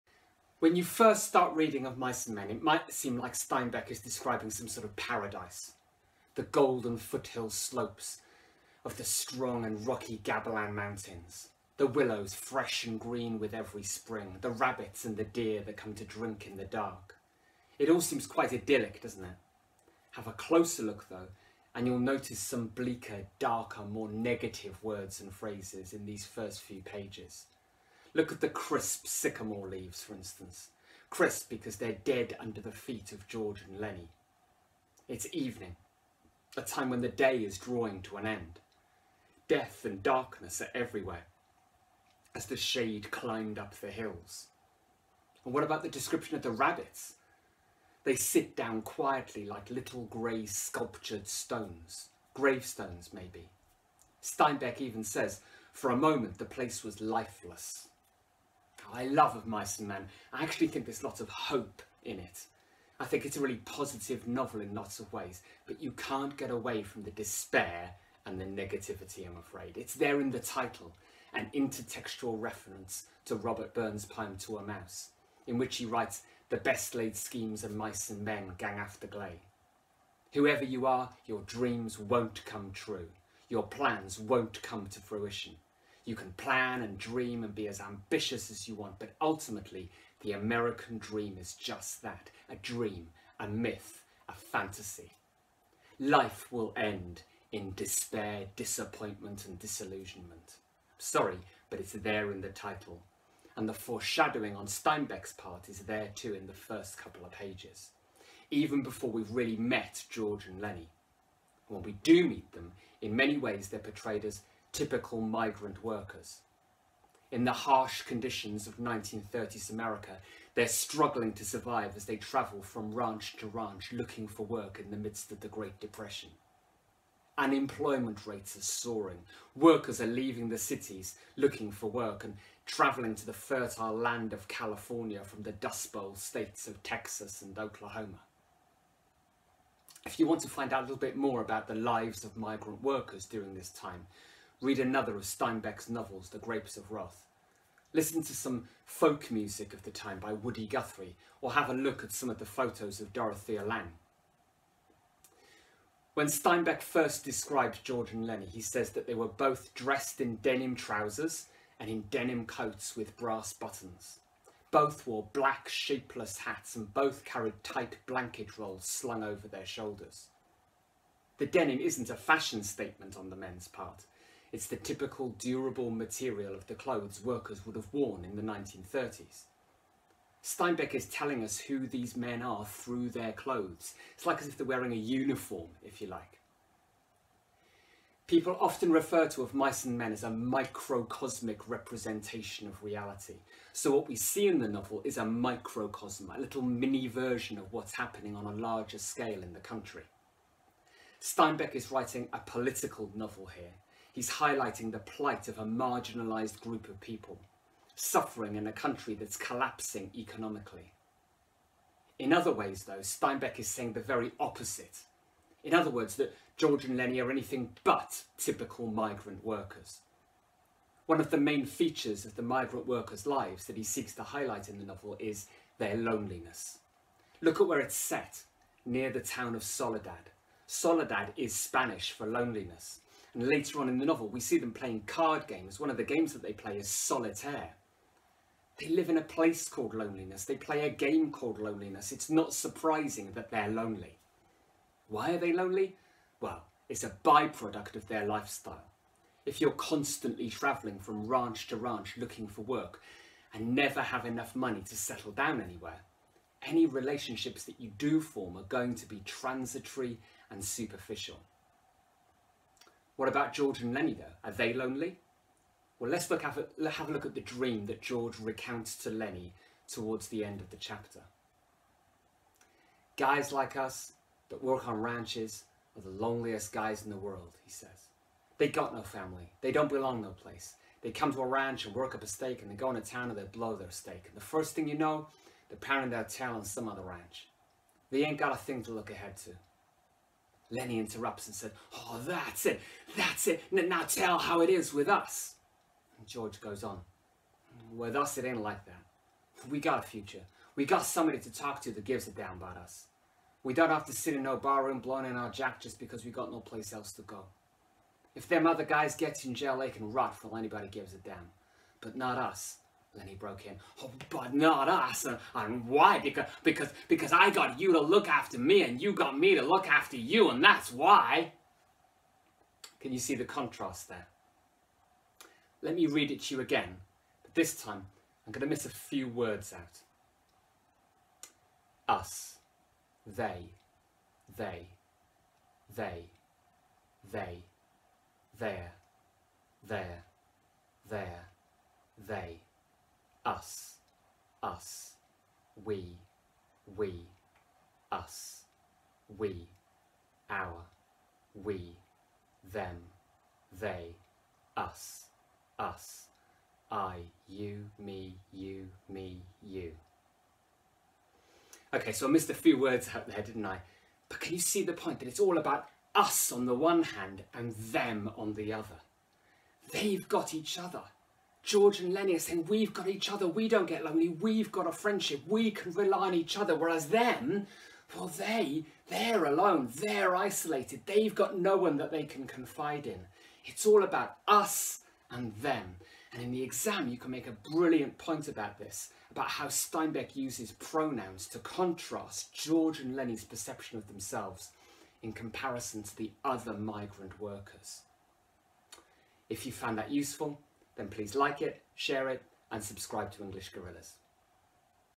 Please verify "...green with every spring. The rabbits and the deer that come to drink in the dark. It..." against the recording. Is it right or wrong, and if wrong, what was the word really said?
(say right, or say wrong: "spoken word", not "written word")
right.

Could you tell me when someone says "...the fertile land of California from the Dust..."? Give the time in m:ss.
2:13.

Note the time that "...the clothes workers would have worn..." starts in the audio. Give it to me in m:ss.
2:56.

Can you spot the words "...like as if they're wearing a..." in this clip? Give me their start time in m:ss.
3:04.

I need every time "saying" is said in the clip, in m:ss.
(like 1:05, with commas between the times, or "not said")
3:33, 6:12.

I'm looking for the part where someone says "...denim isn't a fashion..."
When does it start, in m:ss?
2:51.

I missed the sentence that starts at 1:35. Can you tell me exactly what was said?
Life will end in despair, disappointment, and disillusionment.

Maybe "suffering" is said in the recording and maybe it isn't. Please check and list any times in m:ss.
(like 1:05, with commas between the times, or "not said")
3:27.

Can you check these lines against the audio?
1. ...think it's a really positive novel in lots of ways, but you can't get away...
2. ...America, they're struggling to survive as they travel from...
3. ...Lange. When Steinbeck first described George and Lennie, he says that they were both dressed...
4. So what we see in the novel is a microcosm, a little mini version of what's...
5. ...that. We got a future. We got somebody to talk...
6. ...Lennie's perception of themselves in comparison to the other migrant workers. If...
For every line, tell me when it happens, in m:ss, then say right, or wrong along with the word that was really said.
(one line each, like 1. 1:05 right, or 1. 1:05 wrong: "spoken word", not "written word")
1. 1:03 right
2. 1:59 right
3. 2:33 right
4. 3:13 right
5. 4:58 right
6. 6:33 right.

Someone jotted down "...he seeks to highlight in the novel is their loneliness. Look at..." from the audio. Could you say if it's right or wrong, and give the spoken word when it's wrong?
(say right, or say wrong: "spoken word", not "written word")
right.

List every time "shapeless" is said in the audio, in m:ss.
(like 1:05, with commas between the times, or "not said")
2:45.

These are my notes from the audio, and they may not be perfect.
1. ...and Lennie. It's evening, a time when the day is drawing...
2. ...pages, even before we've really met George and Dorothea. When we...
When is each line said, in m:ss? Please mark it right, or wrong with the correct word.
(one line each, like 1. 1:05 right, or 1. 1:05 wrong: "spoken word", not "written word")
1. 0:33 right
2. 1:47 wrong: "Lennie", not "Dorothea".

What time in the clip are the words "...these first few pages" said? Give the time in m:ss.
0:26.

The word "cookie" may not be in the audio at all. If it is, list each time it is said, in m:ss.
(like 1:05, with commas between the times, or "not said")
not said.